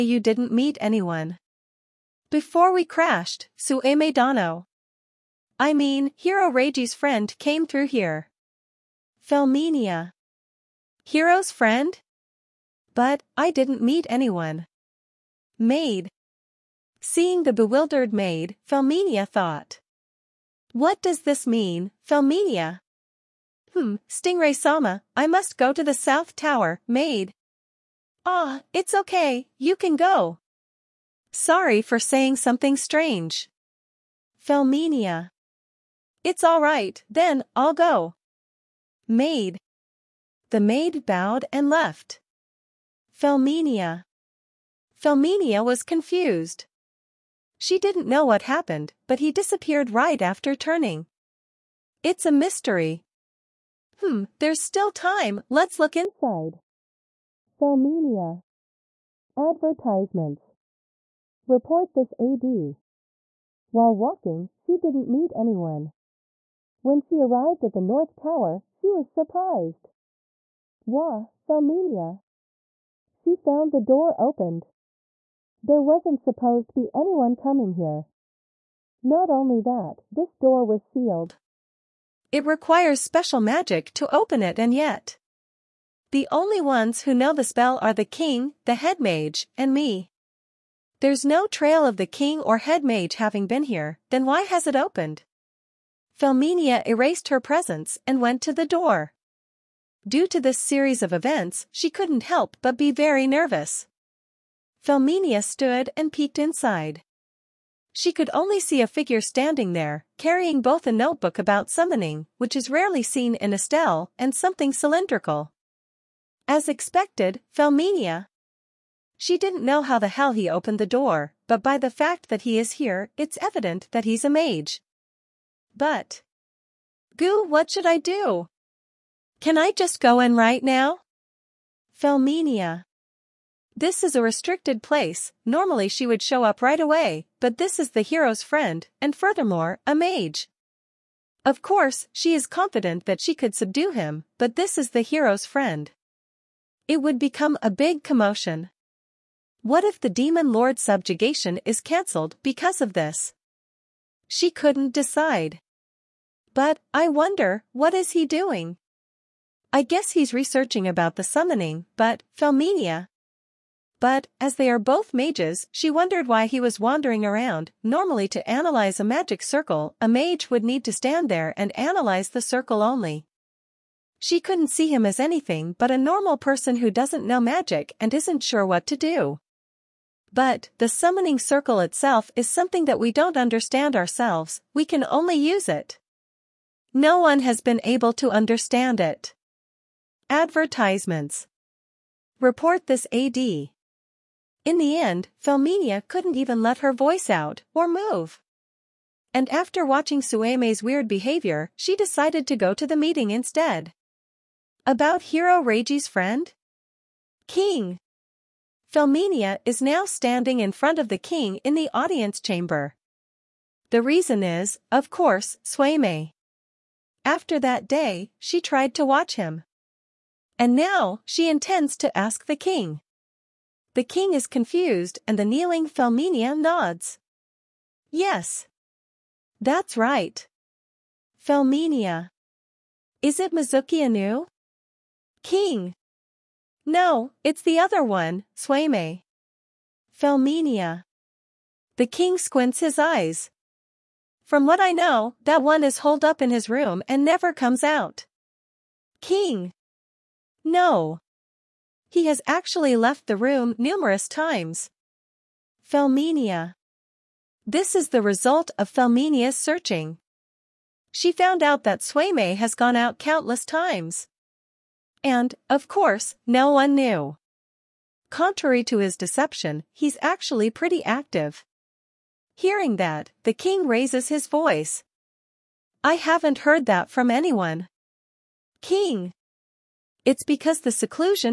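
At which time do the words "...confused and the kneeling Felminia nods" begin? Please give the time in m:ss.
3:44.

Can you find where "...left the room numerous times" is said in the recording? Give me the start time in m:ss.
4:12.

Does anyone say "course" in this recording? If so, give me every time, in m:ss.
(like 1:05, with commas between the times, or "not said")
2:21, 3:35, 4:25.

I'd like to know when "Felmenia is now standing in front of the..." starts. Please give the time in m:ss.
3:28.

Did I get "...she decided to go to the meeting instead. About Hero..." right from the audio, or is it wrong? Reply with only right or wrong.
right.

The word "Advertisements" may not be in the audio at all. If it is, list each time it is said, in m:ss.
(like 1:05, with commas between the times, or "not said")
0:59, 3:10.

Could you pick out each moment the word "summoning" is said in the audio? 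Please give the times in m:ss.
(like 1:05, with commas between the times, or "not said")
1:51, 2:41, 3:00.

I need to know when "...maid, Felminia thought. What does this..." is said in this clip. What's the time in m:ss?
0:18.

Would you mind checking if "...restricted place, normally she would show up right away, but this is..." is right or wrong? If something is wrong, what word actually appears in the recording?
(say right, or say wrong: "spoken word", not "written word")
right.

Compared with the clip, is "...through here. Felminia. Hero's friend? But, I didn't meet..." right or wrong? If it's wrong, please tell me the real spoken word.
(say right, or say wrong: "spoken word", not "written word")
right.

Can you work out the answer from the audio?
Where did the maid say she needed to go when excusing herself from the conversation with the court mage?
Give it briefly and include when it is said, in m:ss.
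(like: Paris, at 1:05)
The South Tower, at 0:25.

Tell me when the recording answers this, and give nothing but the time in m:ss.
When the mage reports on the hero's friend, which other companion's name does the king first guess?
3:53.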